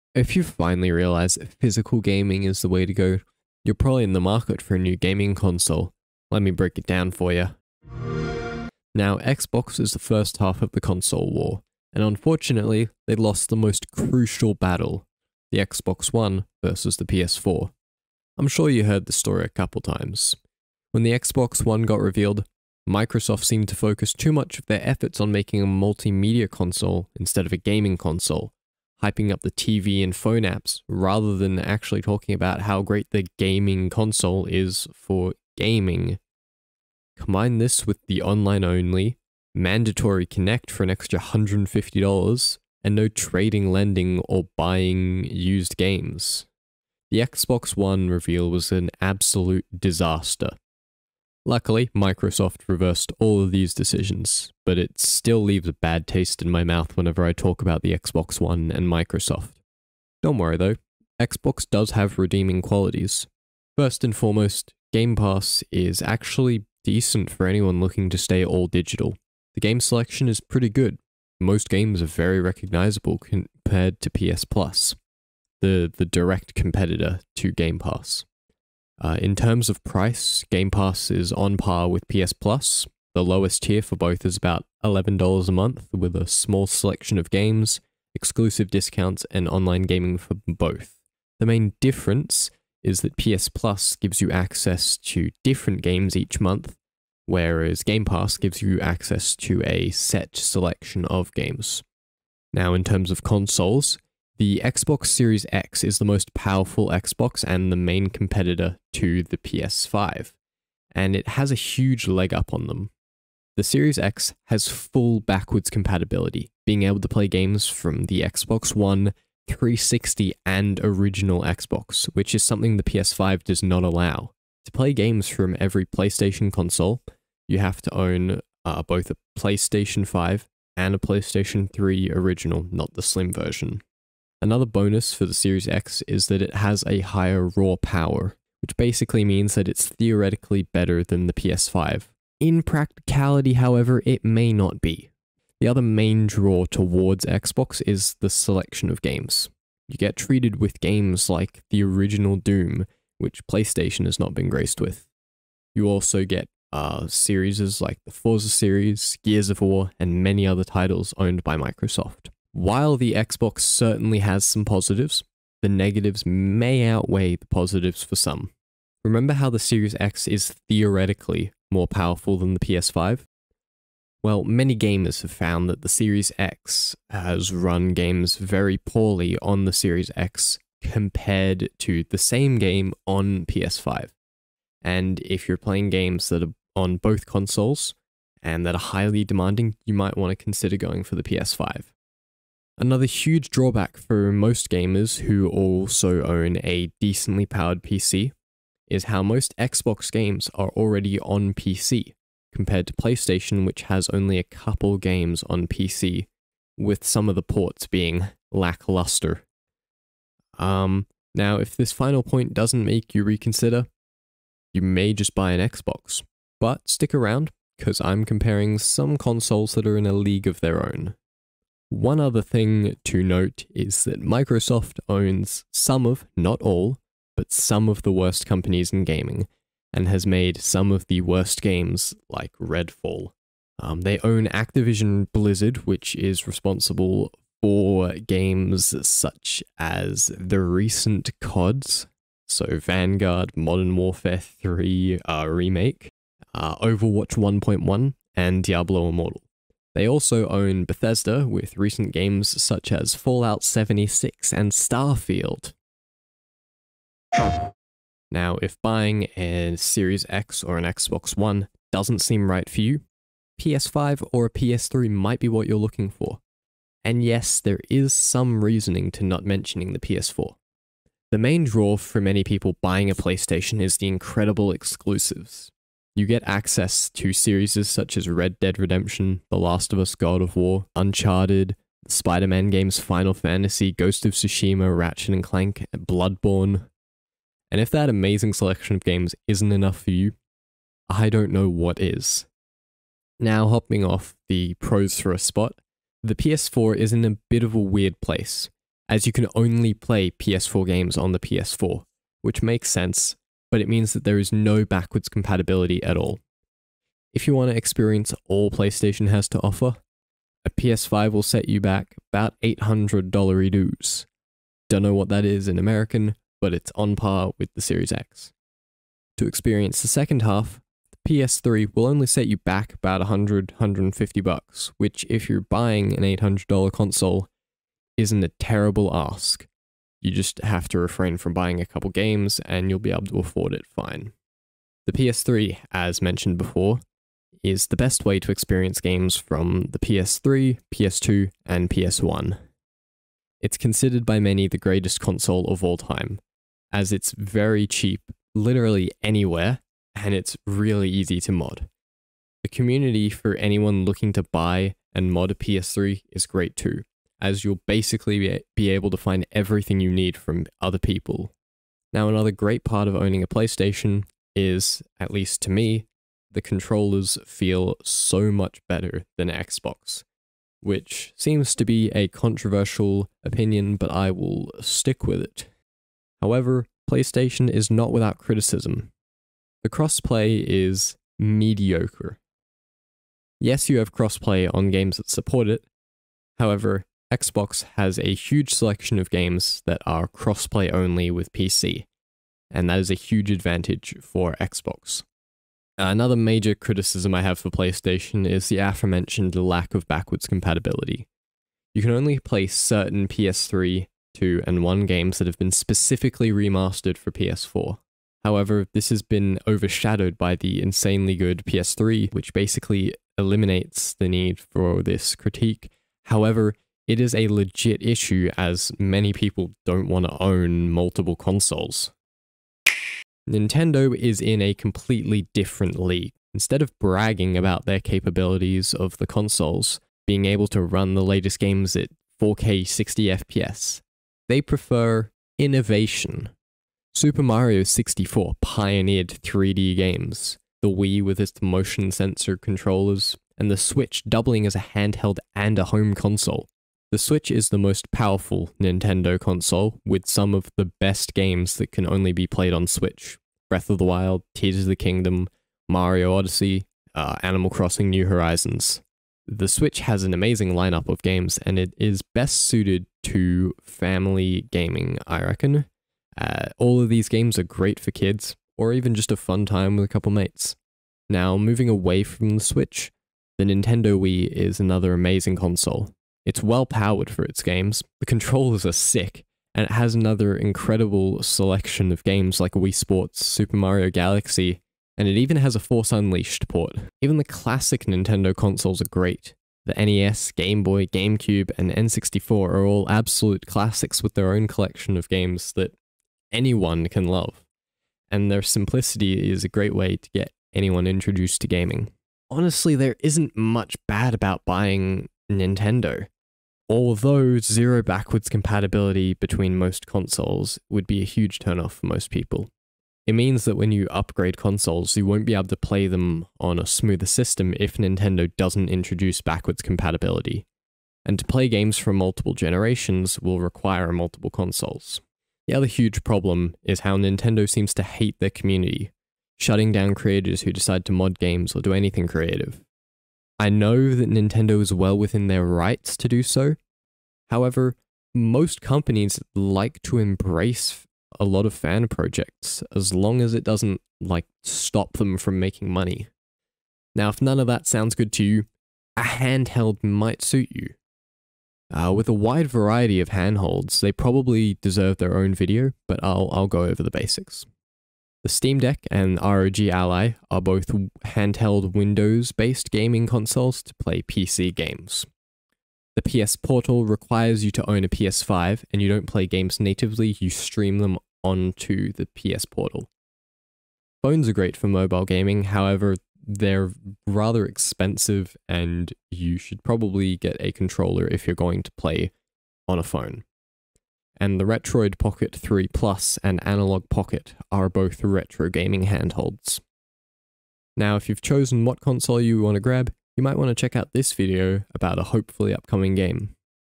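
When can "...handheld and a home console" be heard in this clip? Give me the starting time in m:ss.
7:24.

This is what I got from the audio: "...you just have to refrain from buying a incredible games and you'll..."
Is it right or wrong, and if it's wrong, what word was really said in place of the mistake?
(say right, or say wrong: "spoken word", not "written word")
wrong: "couple", not "incredible".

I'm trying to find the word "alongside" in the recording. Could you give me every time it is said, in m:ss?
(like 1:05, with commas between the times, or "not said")
not said.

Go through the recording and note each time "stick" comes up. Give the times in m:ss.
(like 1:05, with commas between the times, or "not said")
3:36, 6:14.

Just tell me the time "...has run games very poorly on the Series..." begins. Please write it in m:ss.
2:57.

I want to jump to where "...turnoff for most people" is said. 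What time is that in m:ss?
8:31.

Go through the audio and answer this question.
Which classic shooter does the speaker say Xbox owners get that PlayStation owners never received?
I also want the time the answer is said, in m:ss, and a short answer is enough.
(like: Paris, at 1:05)
Doom, at 2:32.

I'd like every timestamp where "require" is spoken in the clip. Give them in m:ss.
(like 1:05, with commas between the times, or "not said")
8:43, 9:27.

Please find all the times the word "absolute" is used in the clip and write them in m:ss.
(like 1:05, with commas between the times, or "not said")
0:49, 8:13.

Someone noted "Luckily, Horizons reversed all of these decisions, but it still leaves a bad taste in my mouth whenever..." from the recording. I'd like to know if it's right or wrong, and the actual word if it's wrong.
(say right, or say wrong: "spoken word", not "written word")
wrong: "Microsoft", not "Horizons".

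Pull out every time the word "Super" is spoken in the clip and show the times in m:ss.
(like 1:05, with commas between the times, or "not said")
7:17, 8:03.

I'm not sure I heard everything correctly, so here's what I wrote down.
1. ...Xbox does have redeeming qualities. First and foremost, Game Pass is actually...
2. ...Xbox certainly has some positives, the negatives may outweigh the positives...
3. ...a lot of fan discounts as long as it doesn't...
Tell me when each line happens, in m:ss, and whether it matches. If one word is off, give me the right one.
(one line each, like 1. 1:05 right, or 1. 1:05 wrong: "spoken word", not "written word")
1. 1:01 right
2. 2:43 right
3. 9:01 wrong: "projects", not "discounts".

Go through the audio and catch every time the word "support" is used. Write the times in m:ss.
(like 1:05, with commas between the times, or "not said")
6:25.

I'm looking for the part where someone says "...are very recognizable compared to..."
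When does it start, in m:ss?
1:12.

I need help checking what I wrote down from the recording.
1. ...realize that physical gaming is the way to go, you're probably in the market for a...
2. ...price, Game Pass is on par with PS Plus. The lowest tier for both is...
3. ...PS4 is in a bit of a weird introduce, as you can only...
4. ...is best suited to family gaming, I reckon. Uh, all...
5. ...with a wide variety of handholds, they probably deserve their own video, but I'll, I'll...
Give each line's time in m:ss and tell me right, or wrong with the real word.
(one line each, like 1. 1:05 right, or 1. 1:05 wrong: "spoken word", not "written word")
1. 0:00 right
2. 1:19 right
3. 4:56 wrong: "place", not "introduce"
4. 7:41 right
5. 9:12 right.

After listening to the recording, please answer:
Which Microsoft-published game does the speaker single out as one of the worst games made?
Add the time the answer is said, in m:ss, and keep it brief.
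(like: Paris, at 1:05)
Redfall, at 3:52.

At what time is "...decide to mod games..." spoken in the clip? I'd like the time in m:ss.
8:50.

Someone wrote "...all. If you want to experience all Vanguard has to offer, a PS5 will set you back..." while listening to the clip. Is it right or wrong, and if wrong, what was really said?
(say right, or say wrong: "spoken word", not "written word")
wrong: "PlayStation", not "Vanguard".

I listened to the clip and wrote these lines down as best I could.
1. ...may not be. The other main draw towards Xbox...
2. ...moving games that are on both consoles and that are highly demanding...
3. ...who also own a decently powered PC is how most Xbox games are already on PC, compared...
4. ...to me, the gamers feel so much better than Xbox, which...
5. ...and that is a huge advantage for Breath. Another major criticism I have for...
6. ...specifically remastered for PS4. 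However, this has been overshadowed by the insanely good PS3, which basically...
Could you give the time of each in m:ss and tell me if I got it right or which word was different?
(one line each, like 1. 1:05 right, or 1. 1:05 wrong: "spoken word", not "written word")
1. 2:24 right
2. 3:05 wrong: "playing", not "moving"
3. 3:15 right
4. 6:05 wrong: "controllers", not "gamers"
5. 6:32 wrong: "Xbox", not "Breath"
6. 6:45 right.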